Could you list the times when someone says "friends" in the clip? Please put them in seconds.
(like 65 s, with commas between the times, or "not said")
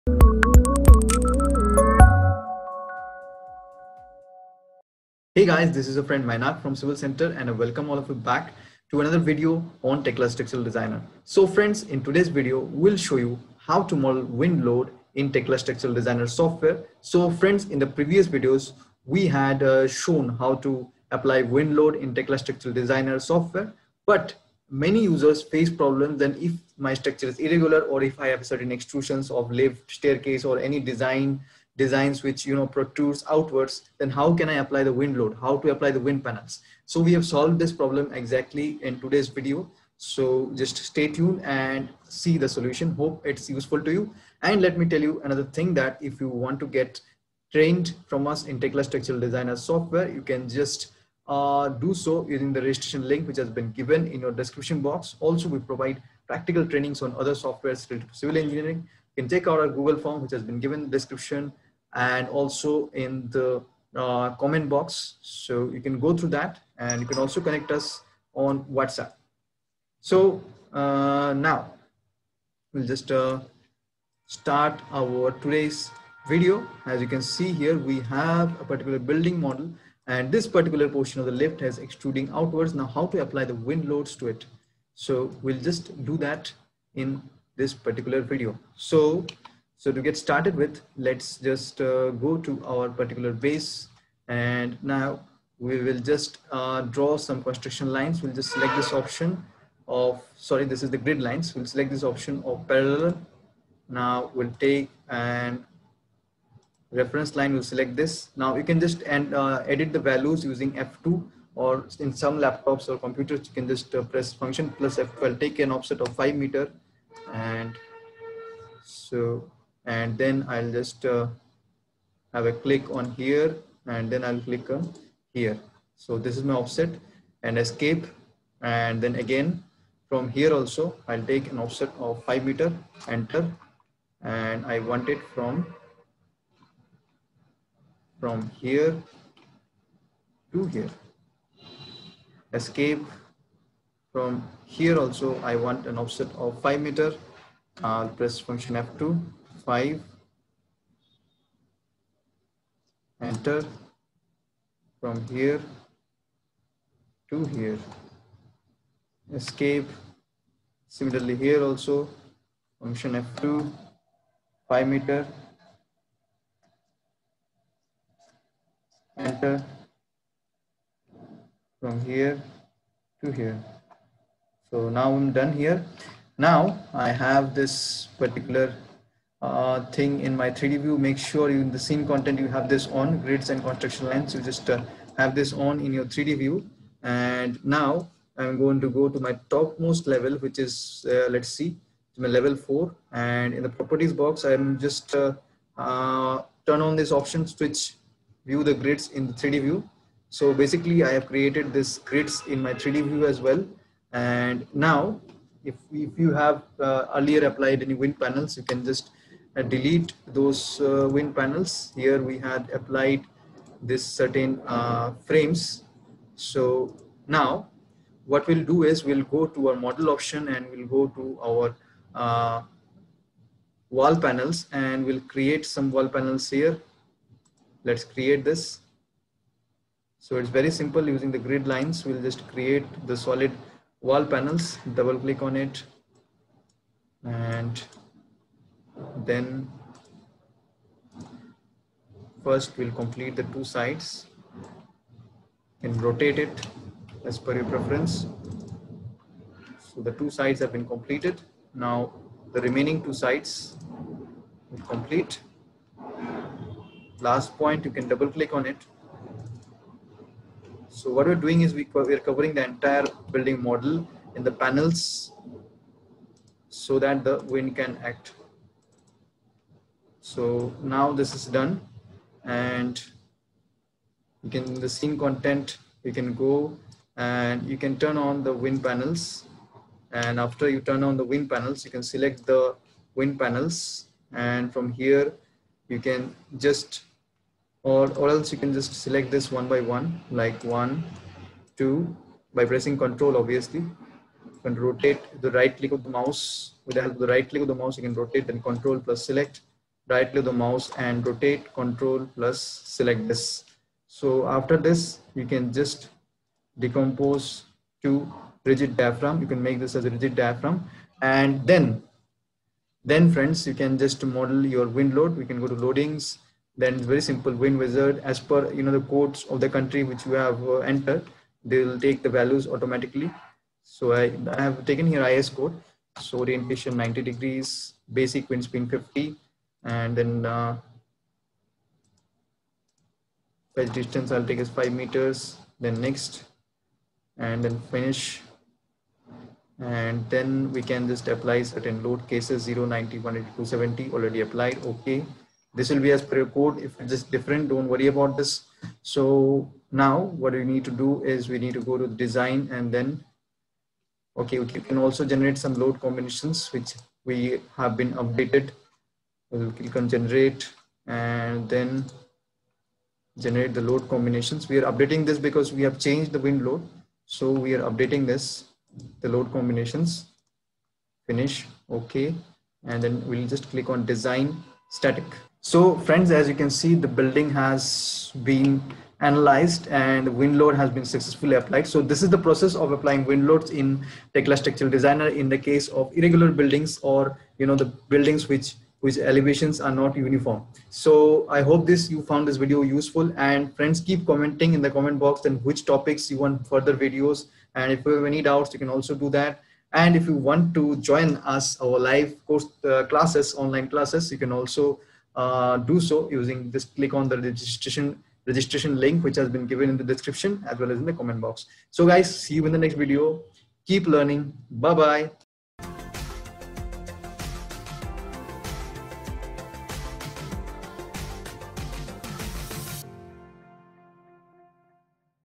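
6 s, 11 s, 17 s, 313 s, 375 s, 393 s.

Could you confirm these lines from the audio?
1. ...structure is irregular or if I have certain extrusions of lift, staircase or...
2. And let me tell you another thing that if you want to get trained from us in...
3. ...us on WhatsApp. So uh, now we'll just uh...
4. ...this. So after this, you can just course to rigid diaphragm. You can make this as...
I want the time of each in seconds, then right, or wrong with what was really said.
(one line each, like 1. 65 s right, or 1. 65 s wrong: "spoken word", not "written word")
1. 26 s right
2. 44 s right
3. 67 s right
4. 303 s wrong: "decompose", not "course".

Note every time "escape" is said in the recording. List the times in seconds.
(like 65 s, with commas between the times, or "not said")
127 s, 142 s, 159 s.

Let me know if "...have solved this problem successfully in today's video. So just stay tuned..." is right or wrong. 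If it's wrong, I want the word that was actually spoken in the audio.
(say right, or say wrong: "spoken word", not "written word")
wrong: "exactly", not "successfully".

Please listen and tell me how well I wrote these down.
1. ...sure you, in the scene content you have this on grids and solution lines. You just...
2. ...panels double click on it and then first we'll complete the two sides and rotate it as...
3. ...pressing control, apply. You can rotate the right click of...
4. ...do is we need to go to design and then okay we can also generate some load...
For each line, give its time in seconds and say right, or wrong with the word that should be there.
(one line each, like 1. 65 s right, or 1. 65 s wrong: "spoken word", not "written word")
1. 181 s wrong: "construction", not "solution"
2. 234 s right
3. 292 s wrong: "obviously", not "apply"
4. 350 s right.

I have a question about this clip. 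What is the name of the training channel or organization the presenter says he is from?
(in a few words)
Civil Center.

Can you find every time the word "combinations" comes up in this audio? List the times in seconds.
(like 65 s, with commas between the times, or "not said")
355 s, 364 s, 369 s.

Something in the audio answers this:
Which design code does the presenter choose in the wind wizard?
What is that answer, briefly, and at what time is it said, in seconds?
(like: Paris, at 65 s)
IS code, at 325 s.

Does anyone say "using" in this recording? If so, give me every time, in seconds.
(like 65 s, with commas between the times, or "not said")
52 s, 110 s, 231 s, 406 s.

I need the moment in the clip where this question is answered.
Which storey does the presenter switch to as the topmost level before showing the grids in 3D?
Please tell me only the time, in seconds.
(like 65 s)
192 s.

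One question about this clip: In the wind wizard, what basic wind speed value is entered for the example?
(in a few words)
50.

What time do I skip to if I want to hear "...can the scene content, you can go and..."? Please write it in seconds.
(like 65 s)
274 s.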